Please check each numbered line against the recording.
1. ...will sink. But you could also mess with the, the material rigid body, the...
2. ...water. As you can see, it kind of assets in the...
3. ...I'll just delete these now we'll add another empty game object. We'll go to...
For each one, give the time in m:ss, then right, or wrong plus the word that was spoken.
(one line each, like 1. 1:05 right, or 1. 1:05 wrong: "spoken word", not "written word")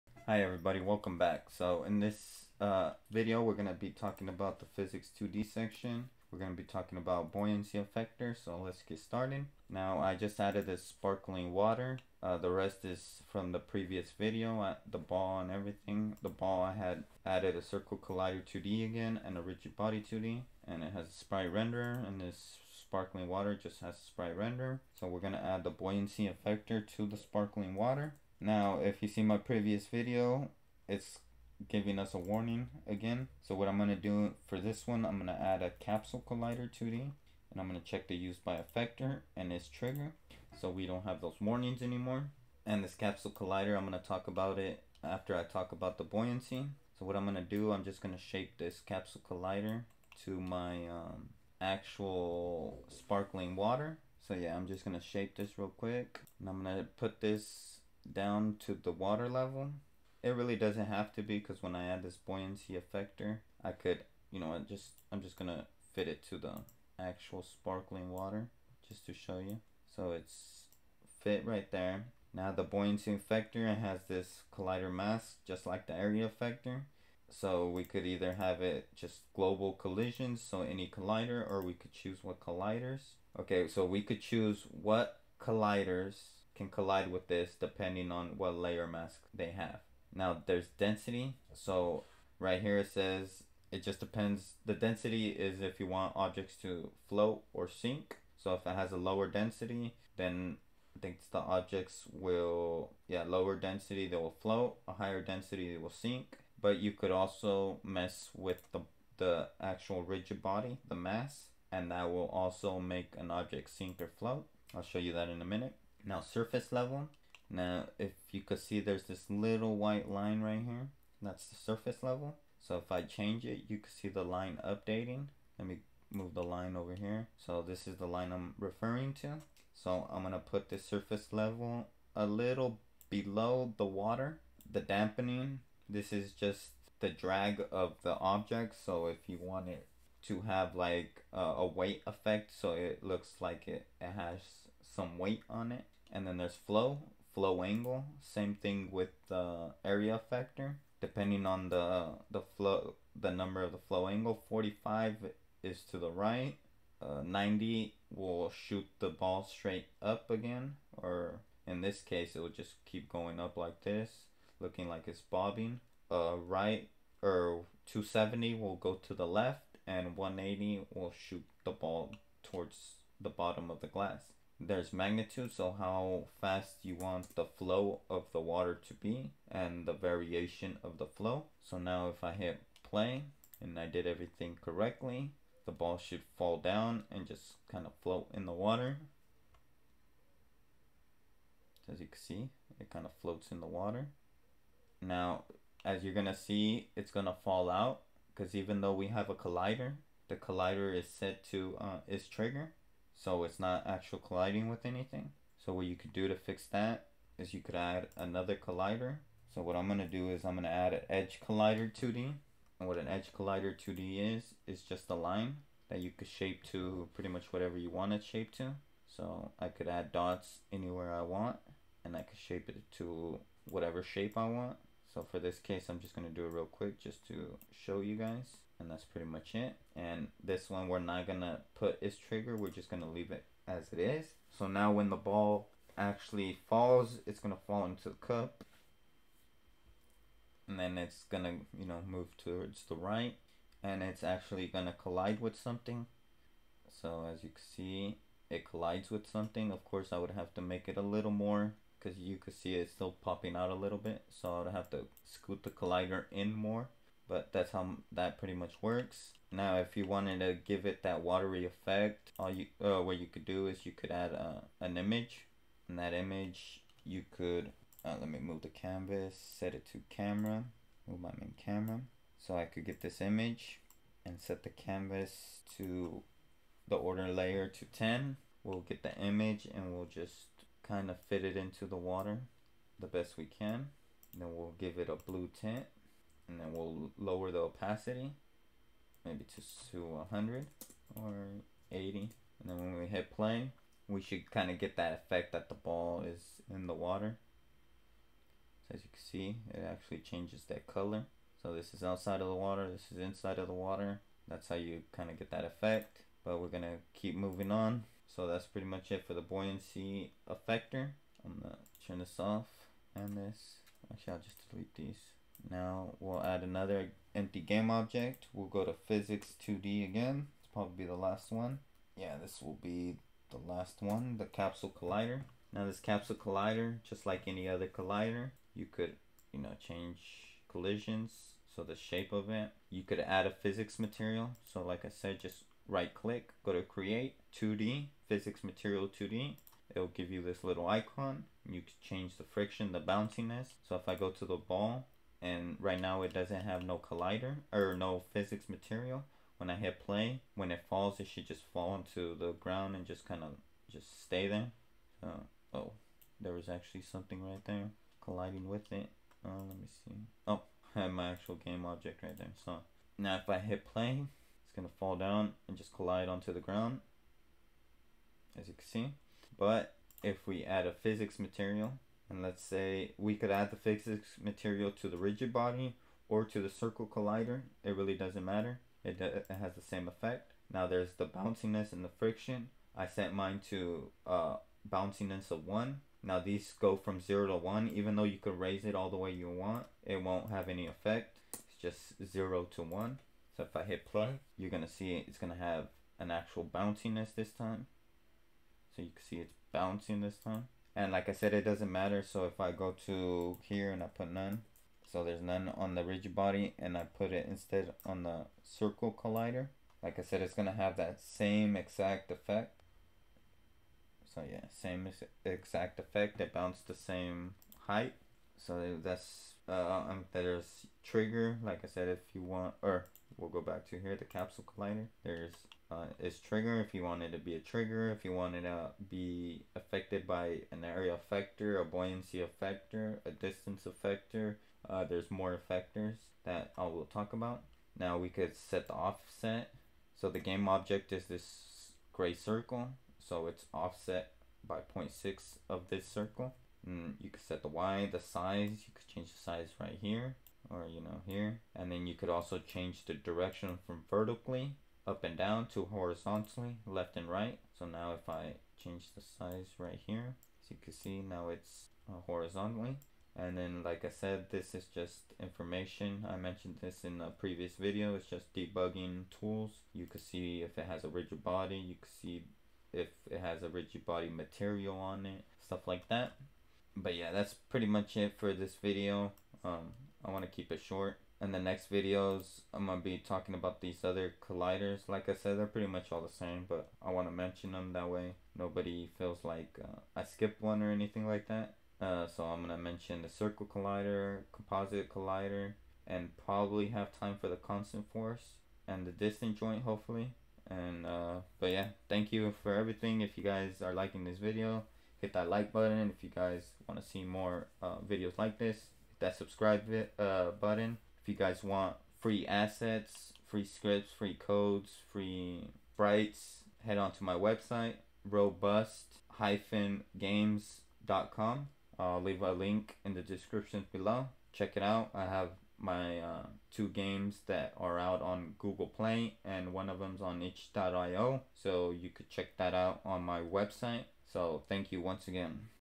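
1. 1:45 wrong: "actual", not "material"
2. 3:08 wrong: "floats", not "assets"
3. 5:14 right.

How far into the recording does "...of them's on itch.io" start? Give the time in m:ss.
8:49.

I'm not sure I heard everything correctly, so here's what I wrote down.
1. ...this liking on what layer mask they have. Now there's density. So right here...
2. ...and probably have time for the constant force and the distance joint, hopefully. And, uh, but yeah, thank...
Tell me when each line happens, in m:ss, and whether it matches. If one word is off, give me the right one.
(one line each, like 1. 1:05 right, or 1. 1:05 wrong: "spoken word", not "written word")
1. 1:27 wrong: "depending", not "liking"
2. 8:16 right.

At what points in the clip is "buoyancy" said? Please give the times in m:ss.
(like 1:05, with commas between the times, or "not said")
0:07, 0:25, 0:46, 1:02, 1:12, 5:09, 7:11.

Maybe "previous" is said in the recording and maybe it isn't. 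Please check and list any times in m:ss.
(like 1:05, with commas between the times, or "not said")
0:13, 0:29, 7:47.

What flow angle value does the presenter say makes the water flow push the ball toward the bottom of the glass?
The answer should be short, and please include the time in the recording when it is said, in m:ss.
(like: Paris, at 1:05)
180, at 2:50.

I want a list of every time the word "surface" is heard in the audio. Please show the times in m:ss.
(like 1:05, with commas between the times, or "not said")
1:56, 2:01, 2:10.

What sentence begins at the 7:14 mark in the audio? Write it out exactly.
Uh, there's more effectors that I will talk about.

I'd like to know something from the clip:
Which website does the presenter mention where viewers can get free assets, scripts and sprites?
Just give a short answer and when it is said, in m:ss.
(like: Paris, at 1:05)
robust-games.com, at 8:38.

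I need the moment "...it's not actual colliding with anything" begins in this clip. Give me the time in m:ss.
3:23.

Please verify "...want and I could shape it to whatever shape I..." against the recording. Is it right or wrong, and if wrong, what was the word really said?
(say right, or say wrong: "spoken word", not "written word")
right.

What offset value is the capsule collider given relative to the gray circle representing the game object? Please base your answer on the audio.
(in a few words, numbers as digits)
0.6.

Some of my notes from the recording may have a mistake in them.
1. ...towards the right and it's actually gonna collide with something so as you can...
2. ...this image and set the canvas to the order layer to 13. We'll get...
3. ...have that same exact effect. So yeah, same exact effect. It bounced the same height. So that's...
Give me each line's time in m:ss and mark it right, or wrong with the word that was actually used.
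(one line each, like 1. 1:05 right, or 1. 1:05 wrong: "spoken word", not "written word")
1. 4:02 right
2. 4:33 wrong: "10", not "13"
3. 6:50 right.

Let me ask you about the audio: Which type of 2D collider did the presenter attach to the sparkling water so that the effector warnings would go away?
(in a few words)
Capsule collider 2D.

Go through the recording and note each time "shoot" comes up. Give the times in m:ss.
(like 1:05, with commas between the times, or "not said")
2:38, 2:51.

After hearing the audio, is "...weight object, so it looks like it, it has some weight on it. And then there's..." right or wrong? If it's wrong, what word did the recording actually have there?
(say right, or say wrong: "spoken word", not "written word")
wrong: "effect", not "object".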